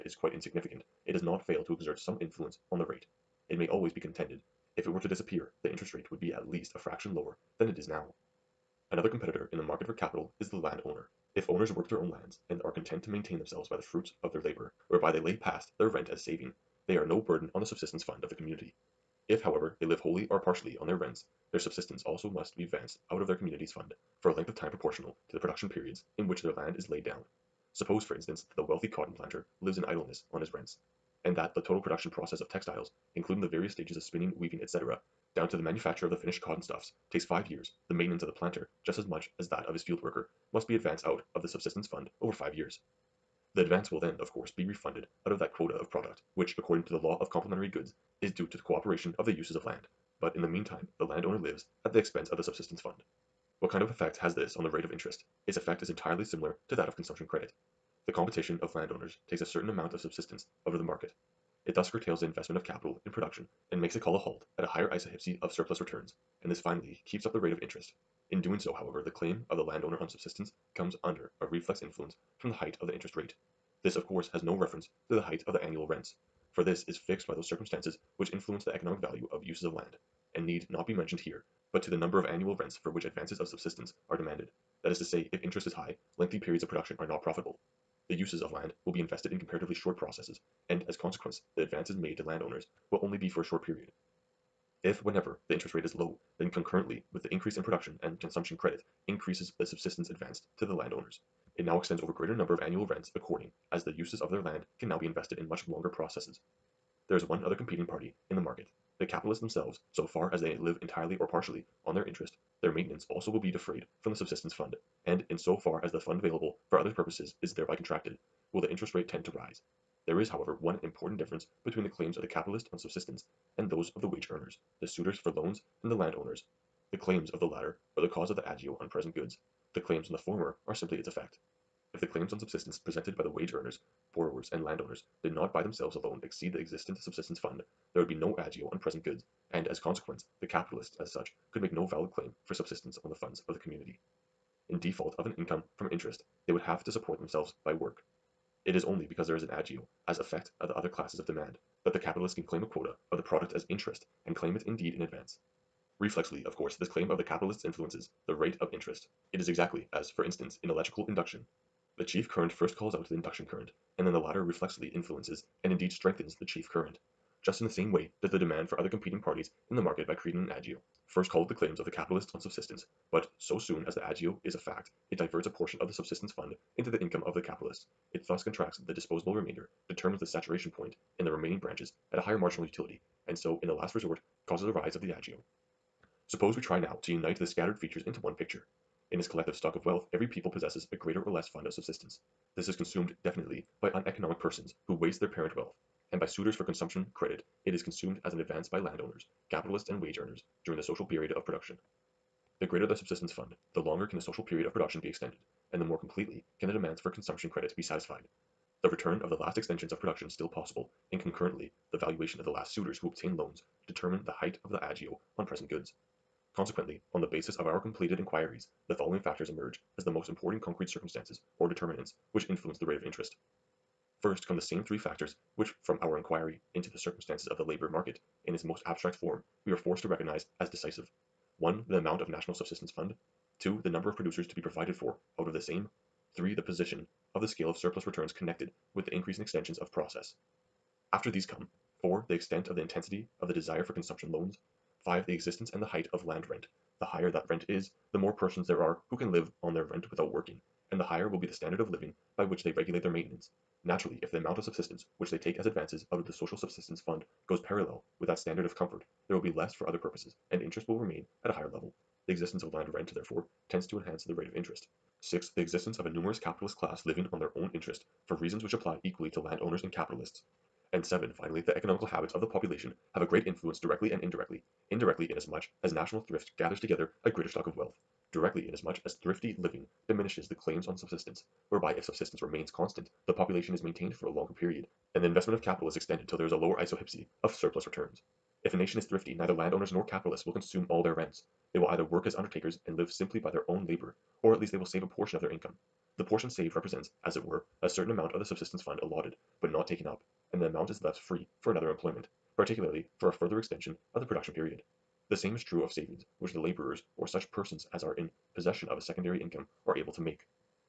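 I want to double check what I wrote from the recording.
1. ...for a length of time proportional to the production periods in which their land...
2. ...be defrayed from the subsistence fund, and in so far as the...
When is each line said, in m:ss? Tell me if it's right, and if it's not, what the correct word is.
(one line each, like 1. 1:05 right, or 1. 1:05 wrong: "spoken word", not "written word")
1. 0:24 right
2. 1:53 right.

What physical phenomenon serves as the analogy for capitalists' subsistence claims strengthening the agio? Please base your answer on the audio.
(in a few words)
Electrical induction.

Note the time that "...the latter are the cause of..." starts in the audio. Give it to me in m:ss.
2:07.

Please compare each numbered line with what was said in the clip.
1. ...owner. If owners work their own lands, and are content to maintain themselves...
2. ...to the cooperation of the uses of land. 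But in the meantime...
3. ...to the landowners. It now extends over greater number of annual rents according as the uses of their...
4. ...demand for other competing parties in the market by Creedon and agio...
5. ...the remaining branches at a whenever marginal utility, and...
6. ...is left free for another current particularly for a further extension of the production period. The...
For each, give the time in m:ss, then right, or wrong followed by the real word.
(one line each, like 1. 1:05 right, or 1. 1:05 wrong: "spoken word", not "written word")
1. 0:10 right
2. 0:48 right
3. 1:40 right
4. 2:48 right
5. 3:01 wrong: "higher", not "whenever"
6. 5:00 wrong: "employment", not "current".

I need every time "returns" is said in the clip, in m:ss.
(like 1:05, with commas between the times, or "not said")
1:05, 3:28, 3:58, 4:47.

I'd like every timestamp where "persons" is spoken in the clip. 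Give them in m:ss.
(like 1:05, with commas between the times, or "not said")
3:14, 4:08, 5:07.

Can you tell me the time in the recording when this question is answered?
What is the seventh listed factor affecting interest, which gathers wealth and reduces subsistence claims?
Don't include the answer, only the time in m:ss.
4:31.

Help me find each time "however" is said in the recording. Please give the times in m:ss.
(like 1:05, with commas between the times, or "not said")
0:19, 1:08, 2:00.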